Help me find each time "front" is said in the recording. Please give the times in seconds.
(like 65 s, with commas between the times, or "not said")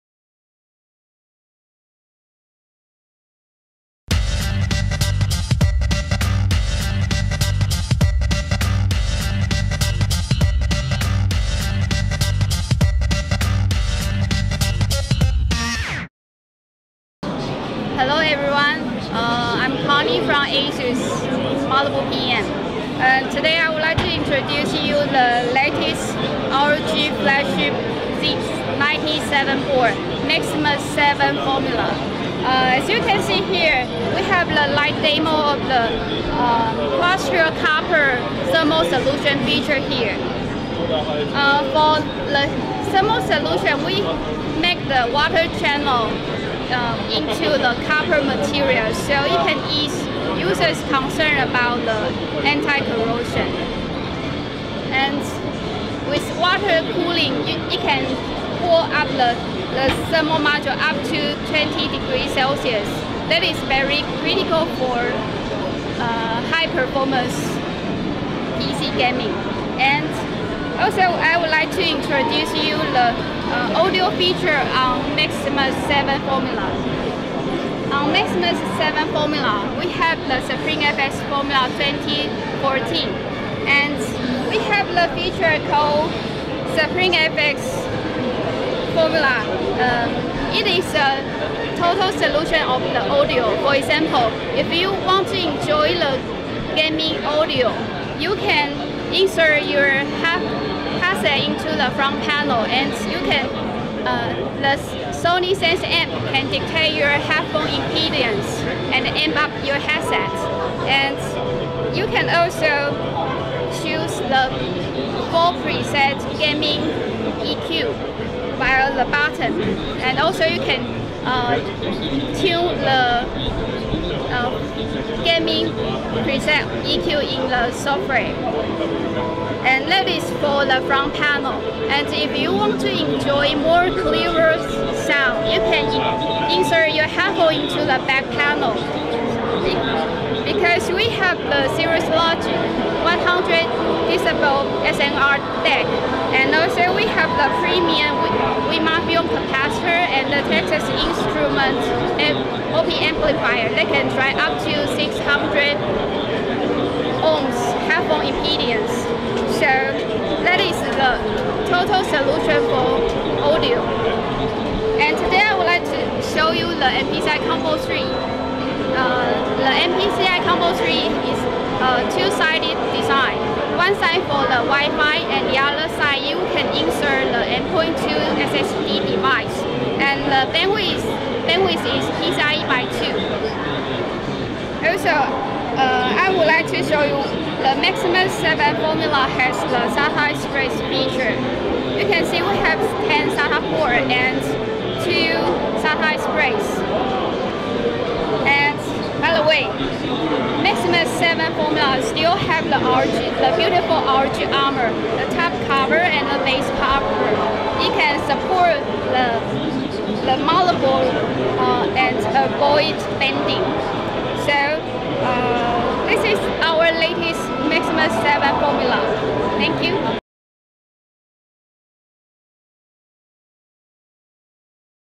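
101 s, 130 s.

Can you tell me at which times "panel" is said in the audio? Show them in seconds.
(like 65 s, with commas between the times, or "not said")
102 s, 131 s, 138 s.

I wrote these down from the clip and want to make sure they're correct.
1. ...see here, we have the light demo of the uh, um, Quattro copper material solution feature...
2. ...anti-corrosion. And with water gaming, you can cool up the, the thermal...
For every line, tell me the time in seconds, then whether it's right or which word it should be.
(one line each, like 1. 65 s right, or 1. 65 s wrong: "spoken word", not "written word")
1. 33 s wrong: "thermal", not "material"
2. 52 s wrong: "cooling", not "gaming".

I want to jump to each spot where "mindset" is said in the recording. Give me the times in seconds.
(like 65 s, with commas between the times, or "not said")
not said.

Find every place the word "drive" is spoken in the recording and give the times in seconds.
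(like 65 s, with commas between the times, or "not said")
154 s.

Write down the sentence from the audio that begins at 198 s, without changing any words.
And by the way, Maximus 7 Formula still have the ROG, the beautiful ROG armor, the top cover and the base cover.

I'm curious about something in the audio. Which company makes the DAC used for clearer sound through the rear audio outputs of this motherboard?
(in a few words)
Cirrus Logic.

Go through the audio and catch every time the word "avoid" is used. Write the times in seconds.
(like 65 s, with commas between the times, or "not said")
212 s.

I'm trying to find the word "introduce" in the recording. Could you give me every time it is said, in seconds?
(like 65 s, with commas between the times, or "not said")
24 s, 71 s.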